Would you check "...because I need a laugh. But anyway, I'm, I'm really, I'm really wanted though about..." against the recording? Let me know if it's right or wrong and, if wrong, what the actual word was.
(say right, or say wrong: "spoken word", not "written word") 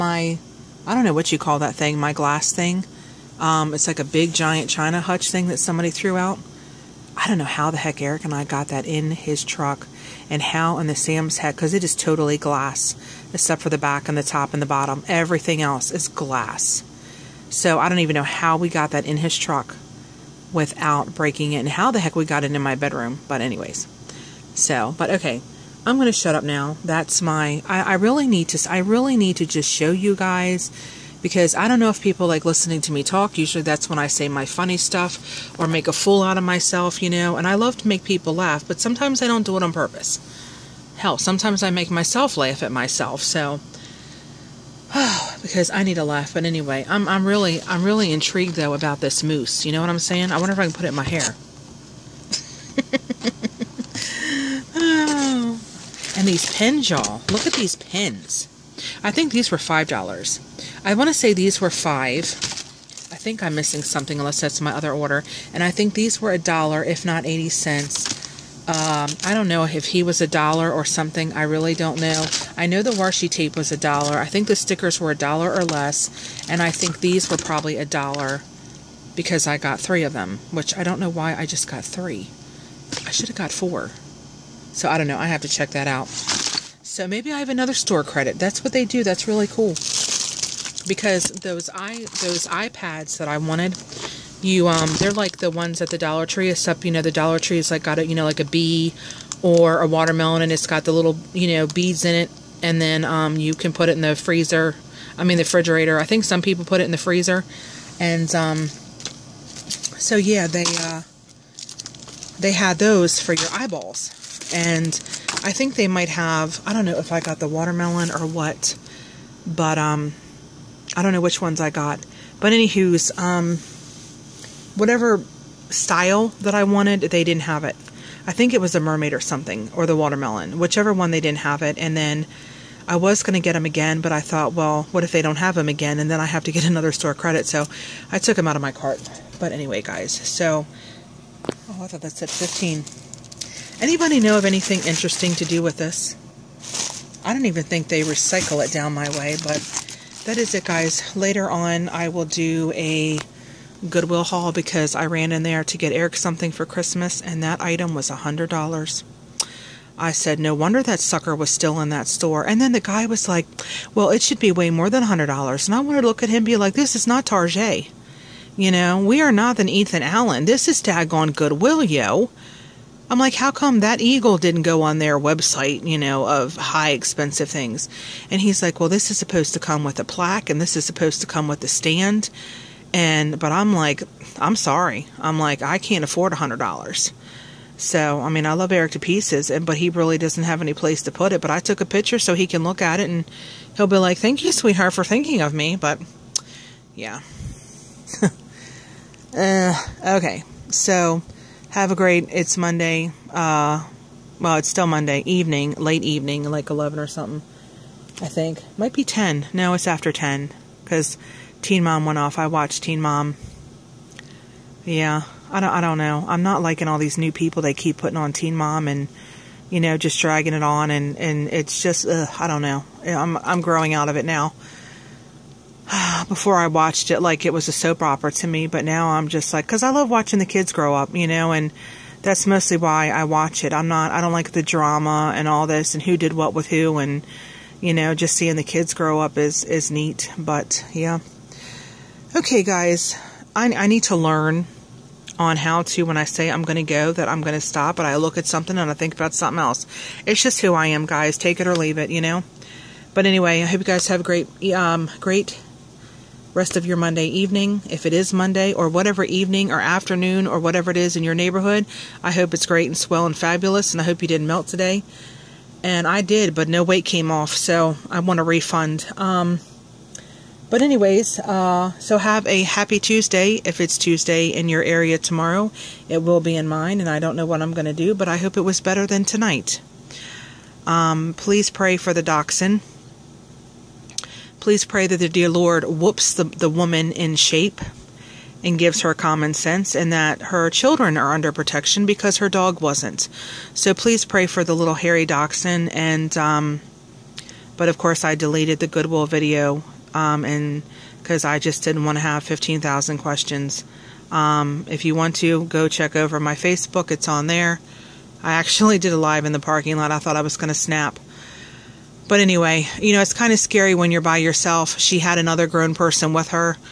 wrong: "intrigued", not "wanted".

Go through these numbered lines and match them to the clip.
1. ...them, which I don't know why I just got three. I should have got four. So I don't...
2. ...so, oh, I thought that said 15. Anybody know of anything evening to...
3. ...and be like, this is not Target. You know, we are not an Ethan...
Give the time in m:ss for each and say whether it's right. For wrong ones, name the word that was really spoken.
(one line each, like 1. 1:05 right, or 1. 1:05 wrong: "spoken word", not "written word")
1. 1:20 right
2. 2:20 wrong: "interesting", not "evening"
3. 2:46 right.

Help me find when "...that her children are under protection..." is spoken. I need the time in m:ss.
4:50.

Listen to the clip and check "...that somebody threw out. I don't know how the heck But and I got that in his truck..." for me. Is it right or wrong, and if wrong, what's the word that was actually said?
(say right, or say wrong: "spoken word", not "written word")
wrong: "Eric", not "But".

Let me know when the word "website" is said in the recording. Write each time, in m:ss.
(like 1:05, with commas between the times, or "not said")
2:55.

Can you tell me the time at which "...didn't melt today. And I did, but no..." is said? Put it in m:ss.
4:24.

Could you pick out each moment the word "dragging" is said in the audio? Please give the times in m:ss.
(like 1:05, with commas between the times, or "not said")
3:40.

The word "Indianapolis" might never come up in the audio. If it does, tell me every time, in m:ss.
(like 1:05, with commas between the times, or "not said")
not said.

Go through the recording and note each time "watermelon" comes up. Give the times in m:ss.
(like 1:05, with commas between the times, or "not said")
1:39, 1:57, 2:09.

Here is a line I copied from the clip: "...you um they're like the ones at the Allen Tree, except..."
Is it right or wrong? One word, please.
wrong.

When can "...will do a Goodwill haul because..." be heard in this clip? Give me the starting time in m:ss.
2:32.